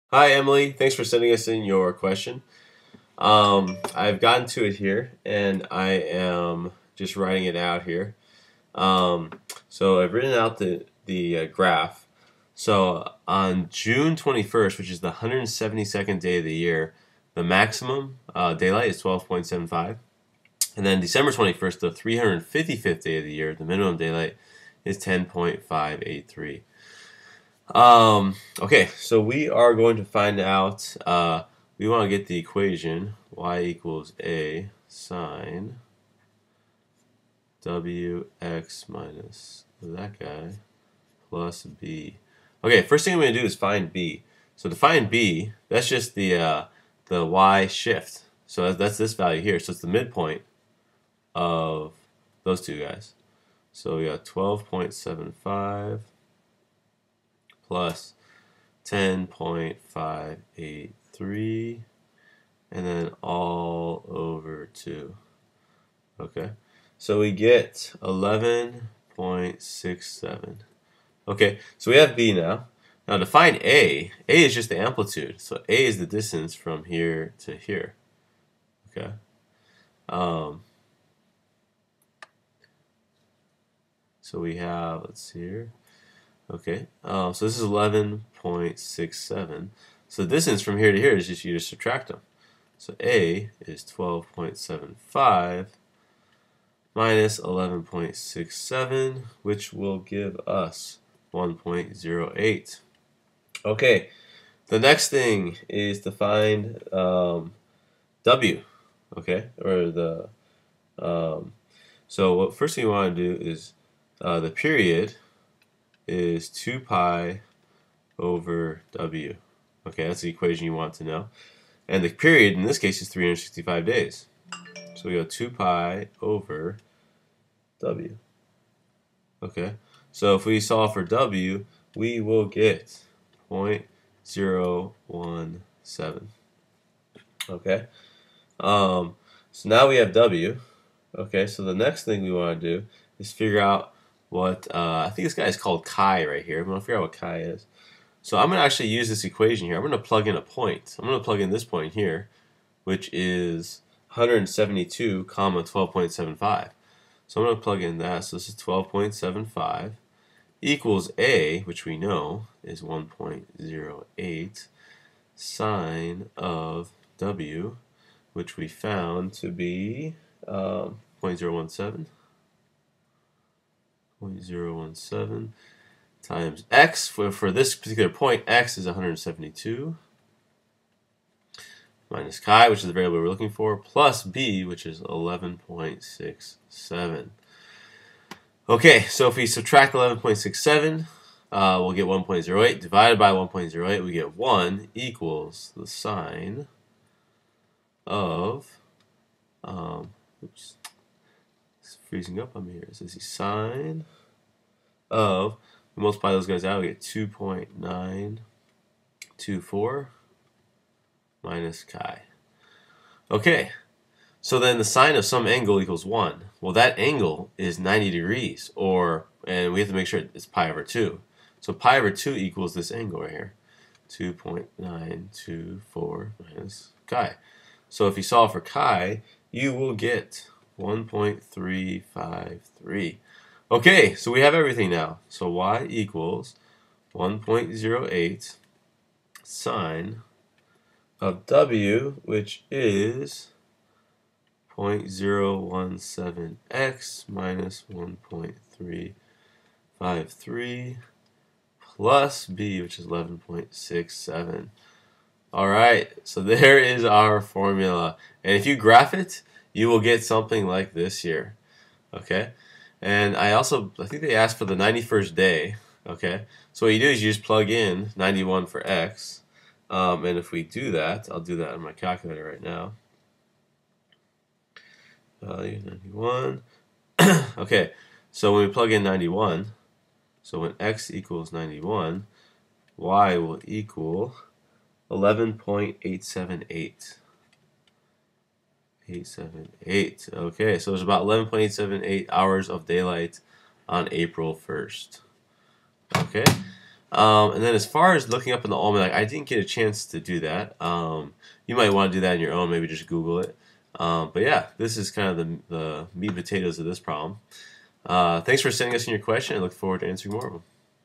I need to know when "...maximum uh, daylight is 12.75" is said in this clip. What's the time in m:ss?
0:17.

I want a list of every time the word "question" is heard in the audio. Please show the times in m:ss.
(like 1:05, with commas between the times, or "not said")
0:01, 5:09.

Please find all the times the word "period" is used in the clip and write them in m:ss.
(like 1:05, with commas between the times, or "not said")
1:54, 2:02.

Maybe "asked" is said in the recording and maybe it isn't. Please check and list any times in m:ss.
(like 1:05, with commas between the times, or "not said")
4:24.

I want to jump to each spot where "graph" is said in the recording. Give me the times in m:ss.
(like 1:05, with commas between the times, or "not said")
0:11, 4:18.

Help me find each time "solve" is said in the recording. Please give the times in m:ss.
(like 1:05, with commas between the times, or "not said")
2:10, 3:48.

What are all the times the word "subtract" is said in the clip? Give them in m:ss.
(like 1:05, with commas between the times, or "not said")
1:31, 3:09.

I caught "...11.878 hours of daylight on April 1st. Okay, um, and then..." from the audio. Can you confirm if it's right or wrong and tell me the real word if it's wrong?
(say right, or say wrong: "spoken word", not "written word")
right.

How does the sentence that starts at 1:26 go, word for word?
Okay, uh, so this is 11.67.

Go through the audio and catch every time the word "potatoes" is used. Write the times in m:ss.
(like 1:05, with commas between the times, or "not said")
5:06.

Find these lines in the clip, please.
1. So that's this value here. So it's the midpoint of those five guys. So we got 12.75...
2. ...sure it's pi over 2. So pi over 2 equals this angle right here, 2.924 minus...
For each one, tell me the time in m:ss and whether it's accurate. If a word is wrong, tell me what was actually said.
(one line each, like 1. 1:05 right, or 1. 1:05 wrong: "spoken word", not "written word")
1. 0:48 wrong: "two", not "five"
2. 3:40 right.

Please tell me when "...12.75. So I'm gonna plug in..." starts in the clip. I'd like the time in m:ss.
2:35.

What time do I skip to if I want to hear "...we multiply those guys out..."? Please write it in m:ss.
3:25.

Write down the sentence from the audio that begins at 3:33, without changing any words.
Okay, so then the sine of some angle equals 1.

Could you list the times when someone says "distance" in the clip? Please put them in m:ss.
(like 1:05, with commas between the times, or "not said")
1:16, 1:30.